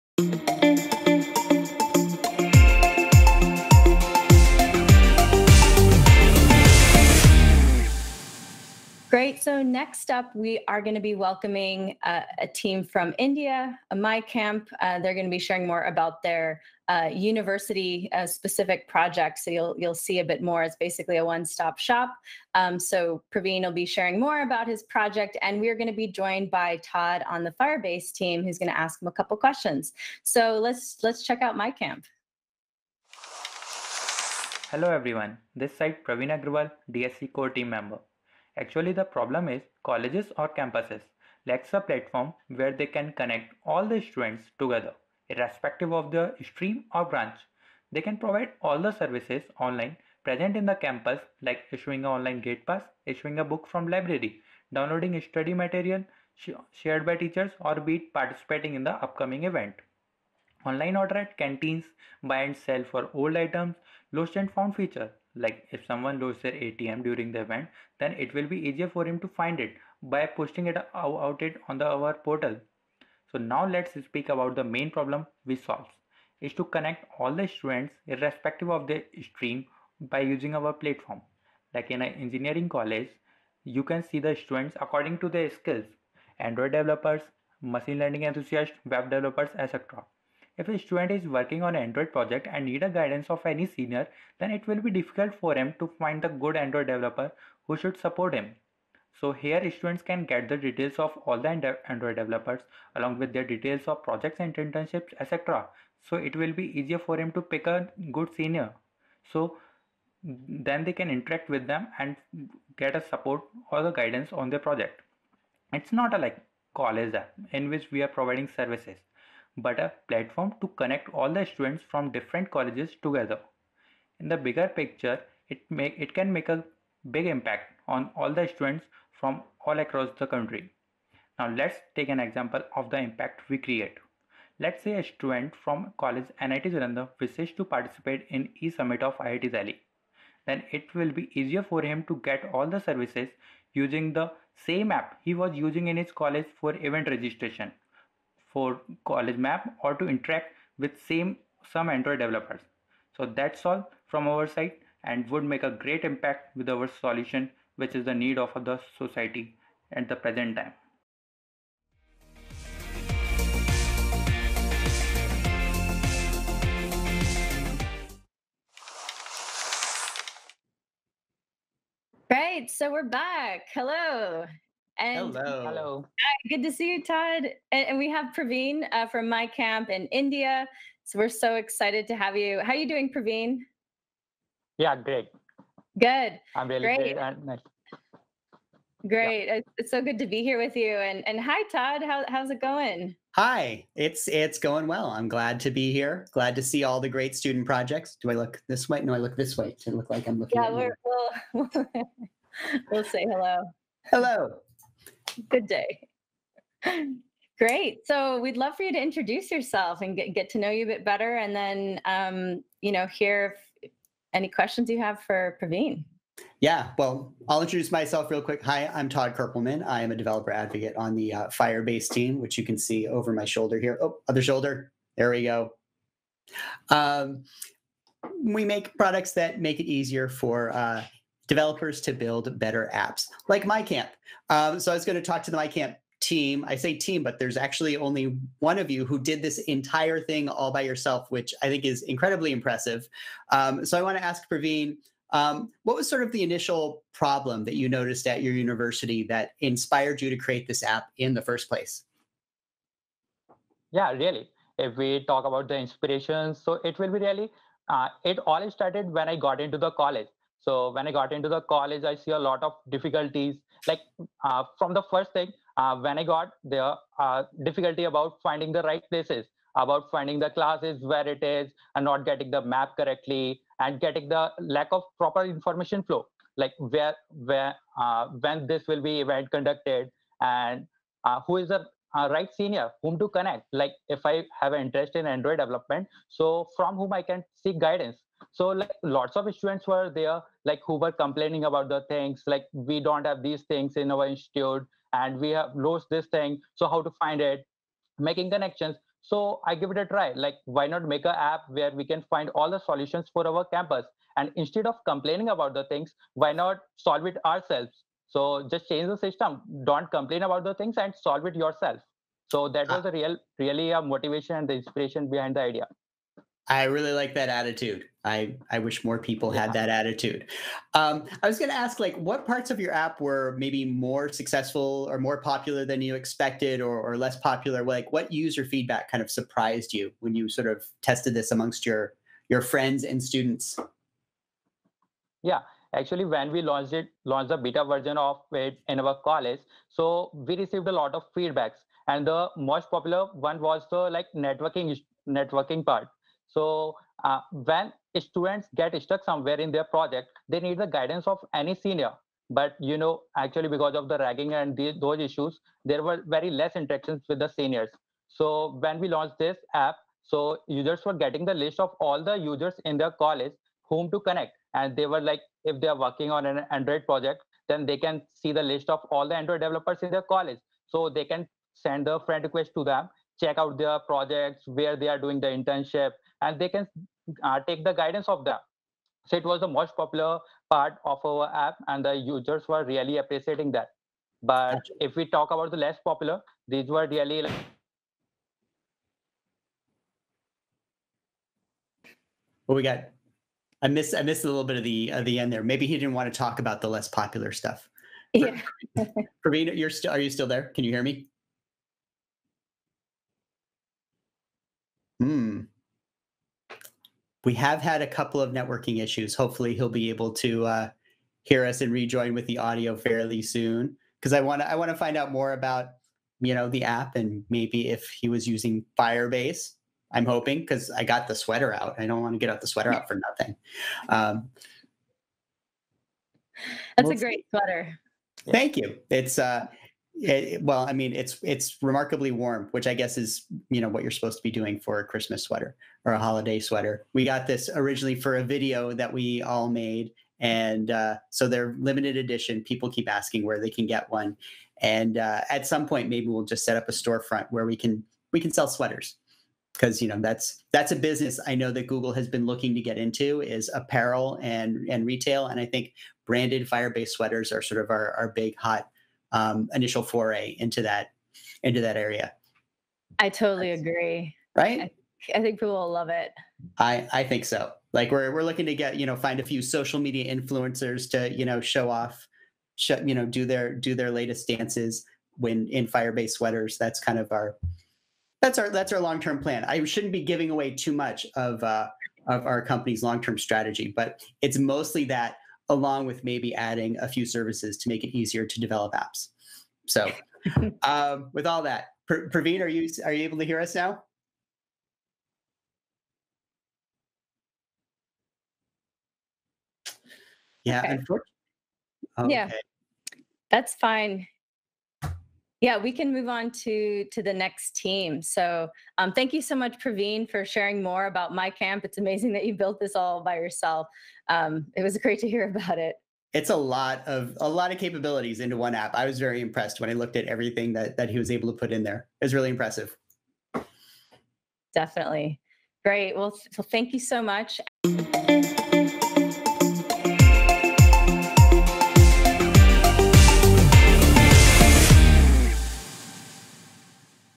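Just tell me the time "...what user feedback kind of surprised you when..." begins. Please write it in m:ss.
5:28.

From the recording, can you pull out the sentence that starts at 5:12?
was a real really a motivation and the inspiration behind the idea I really like that attitude.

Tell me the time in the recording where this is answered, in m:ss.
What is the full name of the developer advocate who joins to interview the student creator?
3:39.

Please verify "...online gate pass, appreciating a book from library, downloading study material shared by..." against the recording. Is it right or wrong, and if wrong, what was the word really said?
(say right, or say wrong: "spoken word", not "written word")
wrong: "issuing", not "appreciating".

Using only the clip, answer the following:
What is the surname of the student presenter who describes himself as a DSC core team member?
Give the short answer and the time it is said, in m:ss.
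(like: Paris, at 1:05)
Agrawal, at 0:36.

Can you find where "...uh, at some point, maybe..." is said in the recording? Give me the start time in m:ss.
7:25.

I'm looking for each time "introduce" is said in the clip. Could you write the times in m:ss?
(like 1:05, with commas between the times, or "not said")
3:29, 3:37.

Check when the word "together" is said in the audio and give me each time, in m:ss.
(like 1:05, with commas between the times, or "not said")
0:44, 2:03.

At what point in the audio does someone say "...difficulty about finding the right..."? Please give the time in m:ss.
4:27.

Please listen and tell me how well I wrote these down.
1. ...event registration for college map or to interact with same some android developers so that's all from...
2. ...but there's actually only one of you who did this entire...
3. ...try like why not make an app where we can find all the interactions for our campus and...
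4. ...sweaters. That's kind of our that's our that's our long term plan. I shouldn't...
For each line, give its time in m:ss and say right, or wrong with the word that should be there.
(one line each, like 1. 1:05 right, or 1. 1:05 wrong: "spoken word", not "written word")
1. 2:26 right
2. 3:57 right
3. 5:00 wrong: "solutions", not "interactions"
4. 7:56 right.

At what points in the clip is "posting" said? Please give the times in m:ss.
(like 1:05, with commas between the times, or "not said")
1:10.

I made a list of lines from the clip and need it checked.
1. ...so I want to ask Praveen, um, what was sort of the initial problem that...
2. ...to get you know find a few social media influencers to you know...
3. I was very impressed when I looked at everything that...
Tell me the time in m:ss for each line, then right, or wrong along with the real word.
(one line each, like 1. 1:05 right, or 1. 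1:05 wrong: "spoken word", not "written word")
1. 4:03 right
2. 7:48 right
3. 8:38 right.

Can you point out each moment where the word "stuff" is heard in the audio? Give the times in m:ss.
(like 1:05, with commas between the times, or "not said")
6:37.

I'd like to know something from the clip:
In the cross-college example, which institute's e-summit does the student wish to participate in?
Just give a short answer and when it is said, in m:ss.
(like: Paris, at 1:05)
IIT Delhi, at 2:19.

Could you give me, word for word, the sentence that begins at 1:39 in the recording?
So here students can get the details of all the Android developers along with their details of projects and internships etc.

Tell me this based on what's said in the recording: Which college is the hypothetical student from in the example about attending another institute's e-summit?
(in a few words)
NIT Jalandhar.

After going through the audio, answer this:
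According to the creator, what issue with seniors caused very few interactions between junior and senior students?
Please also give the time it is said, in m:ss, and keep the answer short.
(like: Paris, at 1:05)
Ragging, at 5:54.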